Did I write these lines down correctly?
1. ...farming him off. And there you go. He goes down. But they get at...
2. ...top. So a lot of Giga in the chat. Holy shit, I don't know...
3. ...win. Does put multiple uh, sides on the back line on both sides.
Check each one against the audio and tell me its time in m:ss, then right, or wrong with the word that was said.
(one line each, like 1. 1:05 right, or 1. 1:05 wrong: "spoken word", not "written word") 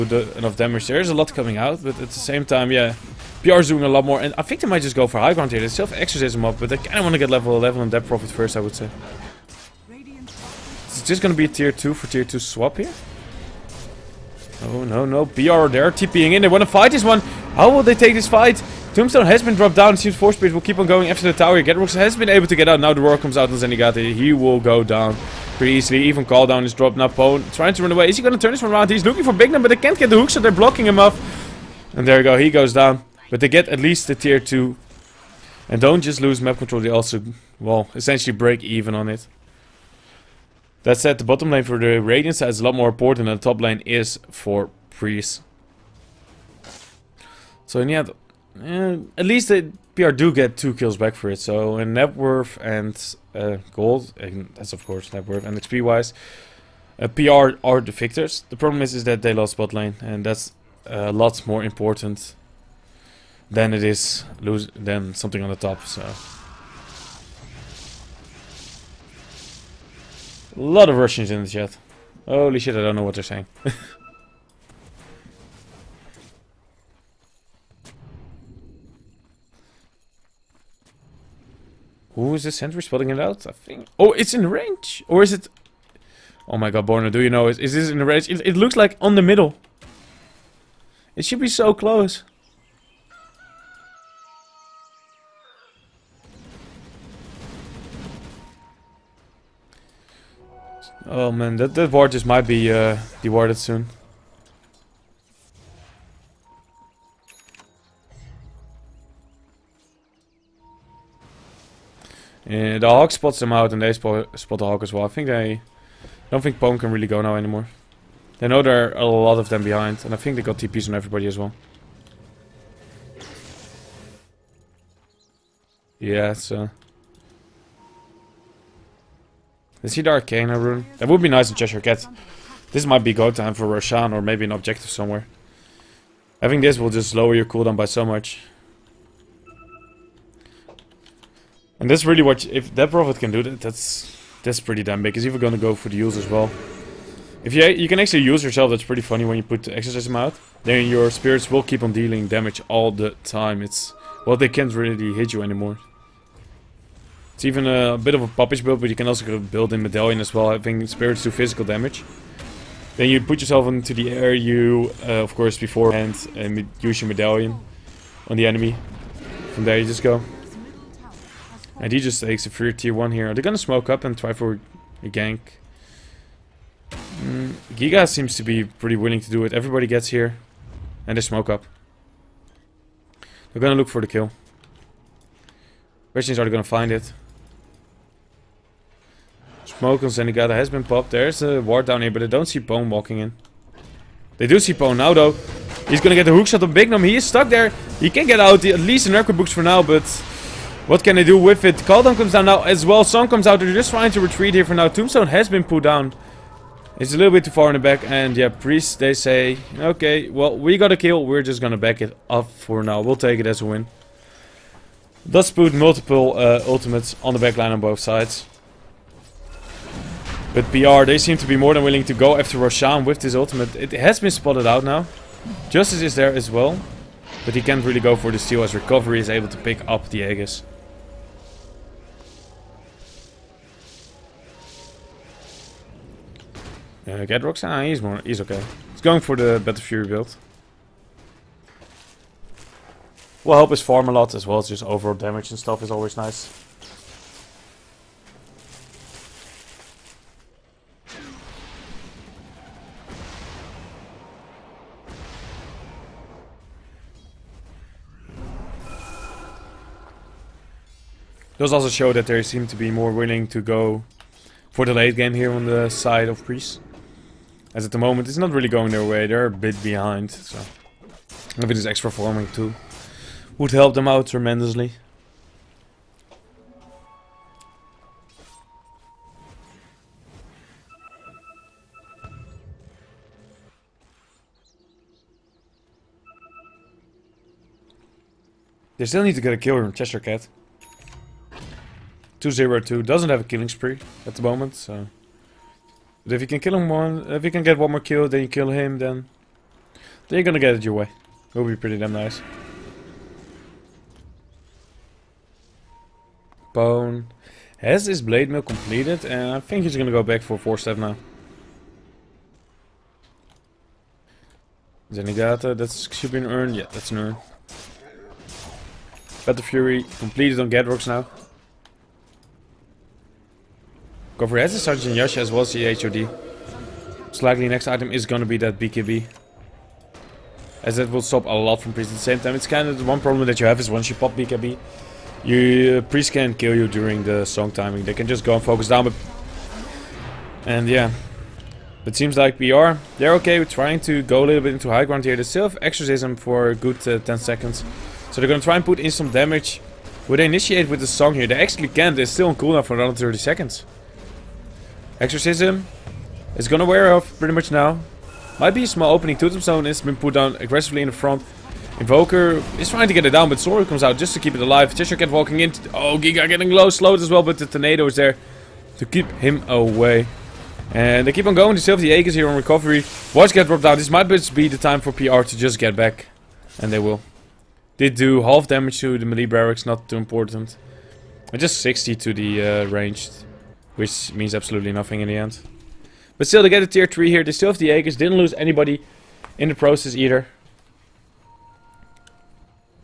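1. 0:30 wrong: "blocking", not "farming"
2. 1:05 wrong: "Russians", not "Giga"
3. 3:33 wrong: "ultimates", not "sides".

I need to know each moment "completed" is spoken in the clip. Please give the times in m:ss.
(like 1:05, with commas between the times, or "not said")
5:08, 5:20.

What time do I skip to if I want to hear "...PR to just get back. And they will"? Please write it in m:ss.
6:15.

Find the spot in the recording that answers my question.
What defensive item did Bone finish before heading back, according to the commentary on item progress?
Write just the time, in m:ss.
5:08.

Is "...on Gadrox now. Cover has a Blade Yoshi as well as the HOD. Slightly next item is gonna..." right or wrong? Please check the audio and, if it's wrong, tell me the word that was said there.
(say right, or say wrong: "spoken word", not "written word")
wrong: "Sergeant", not "Blade".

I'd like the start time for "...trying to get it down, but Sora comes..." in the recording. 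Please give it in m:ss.
6:02.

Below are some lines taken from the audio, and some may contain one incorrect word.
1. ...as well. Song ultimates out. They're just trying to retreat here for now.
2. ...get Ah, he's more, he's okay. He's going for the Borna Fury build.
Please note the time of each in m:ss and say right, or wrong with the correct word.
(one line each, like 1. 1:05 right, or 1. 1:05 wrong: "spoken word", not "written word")
1. 3:22 wrong: "comes", not "ultimates"
2. 3:57 wrong: "Battle", not "Borna".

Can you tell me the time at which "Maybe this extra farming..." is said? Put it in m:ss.
4:31.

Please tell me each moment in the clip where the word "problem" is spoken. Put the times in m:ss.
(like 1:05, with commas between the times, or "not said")
0:58, 5:33.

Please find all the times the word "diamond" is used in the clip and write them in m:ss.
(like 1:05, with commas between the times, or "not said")
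not said.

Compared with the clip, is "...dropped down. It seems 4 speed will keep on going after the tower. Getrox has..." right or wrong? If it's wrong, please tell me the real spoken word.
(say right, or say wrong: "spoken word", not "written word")
right.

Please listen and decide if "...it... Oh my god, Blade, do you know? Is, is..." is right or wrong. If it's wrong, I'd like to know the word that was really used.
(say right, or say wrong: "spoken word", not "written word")
wrong: "Borna", not "Blade".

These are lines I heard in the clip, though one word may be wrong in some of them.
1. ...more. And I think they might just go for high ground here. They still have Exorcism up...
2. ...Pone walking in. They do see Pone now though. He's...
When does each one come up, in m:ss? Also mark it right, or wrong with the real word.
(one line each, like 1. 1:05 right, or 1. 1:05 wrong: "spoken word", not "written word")
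1. 0:04 right
2. 3:12 right.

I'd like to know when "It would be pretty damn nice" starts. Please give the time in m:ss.
5:01.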